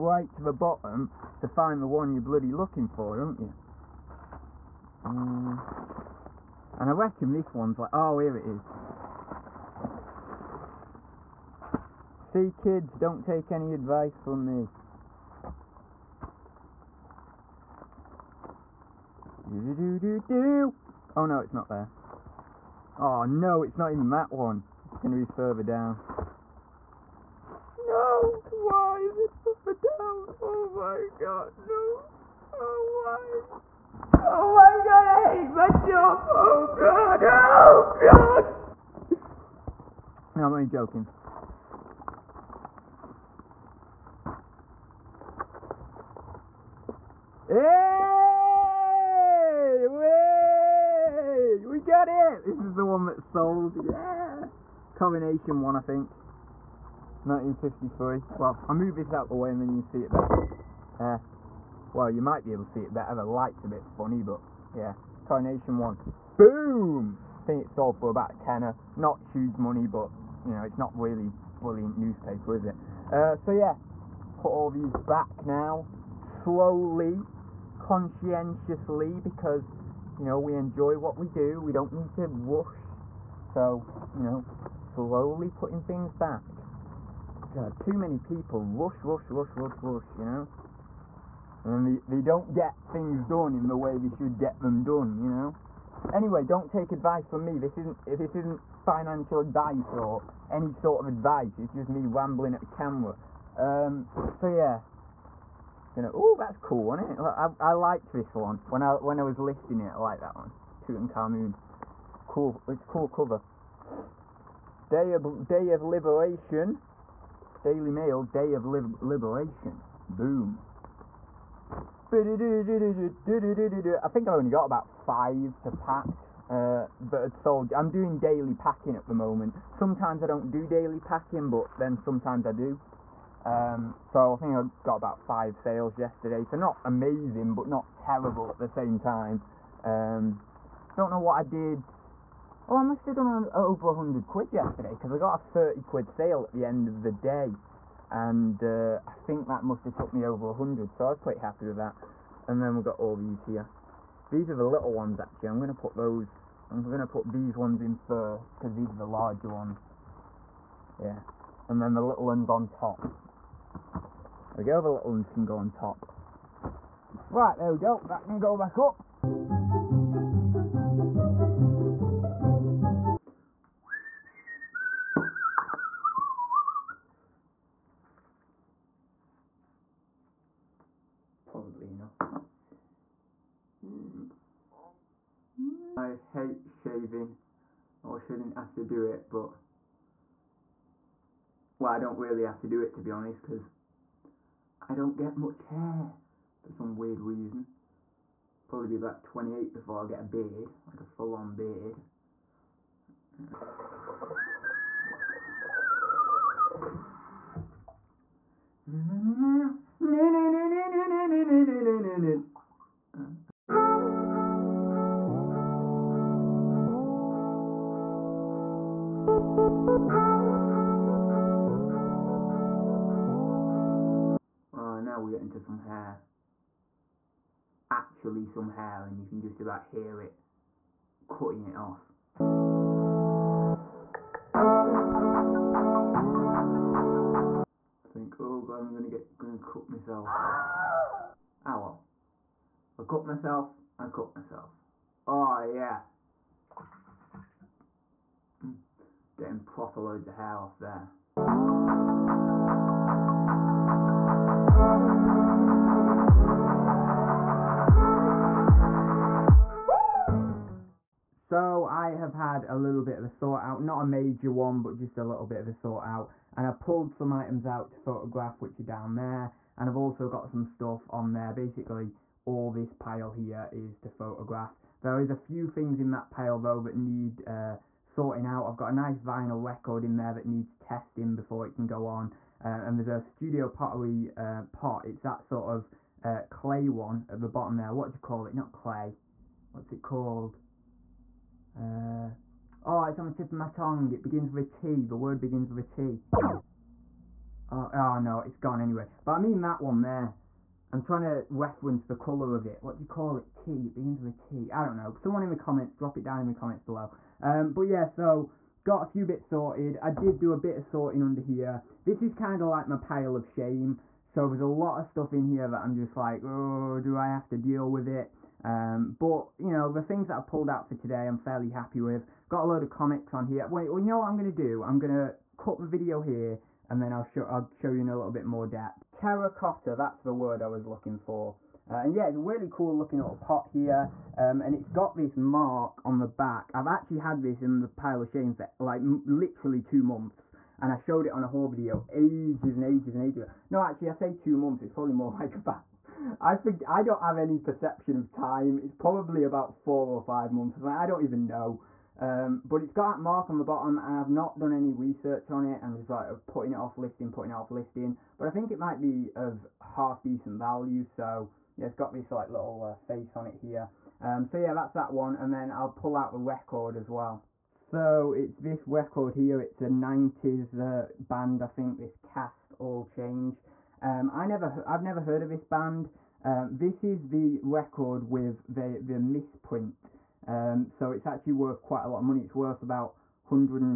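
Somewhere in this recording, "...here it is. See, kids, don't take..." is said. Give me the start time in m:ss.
0:08.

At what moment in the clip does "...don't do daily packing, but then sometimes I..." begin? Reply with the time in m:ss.
2:10.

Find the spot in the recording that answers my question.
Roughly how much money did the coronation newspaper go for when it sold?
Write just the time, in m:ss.
1:08.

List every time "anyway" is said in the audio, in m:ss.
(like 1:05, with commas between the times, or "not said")
1:36, 4:58.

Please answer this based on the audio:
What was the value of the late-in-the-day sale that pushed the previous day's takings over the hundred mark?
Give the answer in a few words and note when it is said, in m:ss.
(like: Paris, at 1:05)
30 quid, at 2:25.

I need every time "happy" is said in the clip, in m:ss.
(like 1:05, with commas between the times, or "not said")
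2:31, 5:21.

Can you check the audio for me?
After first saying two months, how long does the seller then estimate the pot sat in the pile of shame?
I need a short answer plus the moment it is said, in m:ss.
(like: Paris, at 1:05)
4 or 5 months, at 5:49.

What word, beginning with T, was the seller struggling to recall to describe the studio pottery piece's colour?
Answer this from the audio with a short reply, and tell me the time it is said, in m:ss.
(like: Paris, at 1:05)
Terracotta, at 5:29.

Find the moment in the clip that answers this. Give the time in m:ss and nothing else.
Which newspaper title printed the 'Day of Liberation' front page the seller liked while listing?
1:57.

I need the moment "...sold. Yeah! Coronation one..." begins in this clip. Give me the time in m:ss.
0:53.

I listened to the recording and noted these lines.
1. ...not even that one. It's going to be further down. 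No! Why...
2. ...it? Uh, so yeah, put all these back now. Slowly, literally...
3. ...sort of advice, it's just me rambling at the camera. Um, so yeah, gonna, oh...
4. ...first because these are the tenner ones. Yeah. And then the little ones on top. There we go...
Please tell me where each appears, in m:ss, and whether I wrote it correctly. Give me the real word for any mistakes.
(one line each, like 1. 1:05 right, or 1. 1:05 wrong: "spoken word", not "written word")
1. 0:23 right
2. 1:12 wrong: "conscientiously", not "literally"
3. 1:40 right
4. 2:37 wrong: "larger", not "tenner".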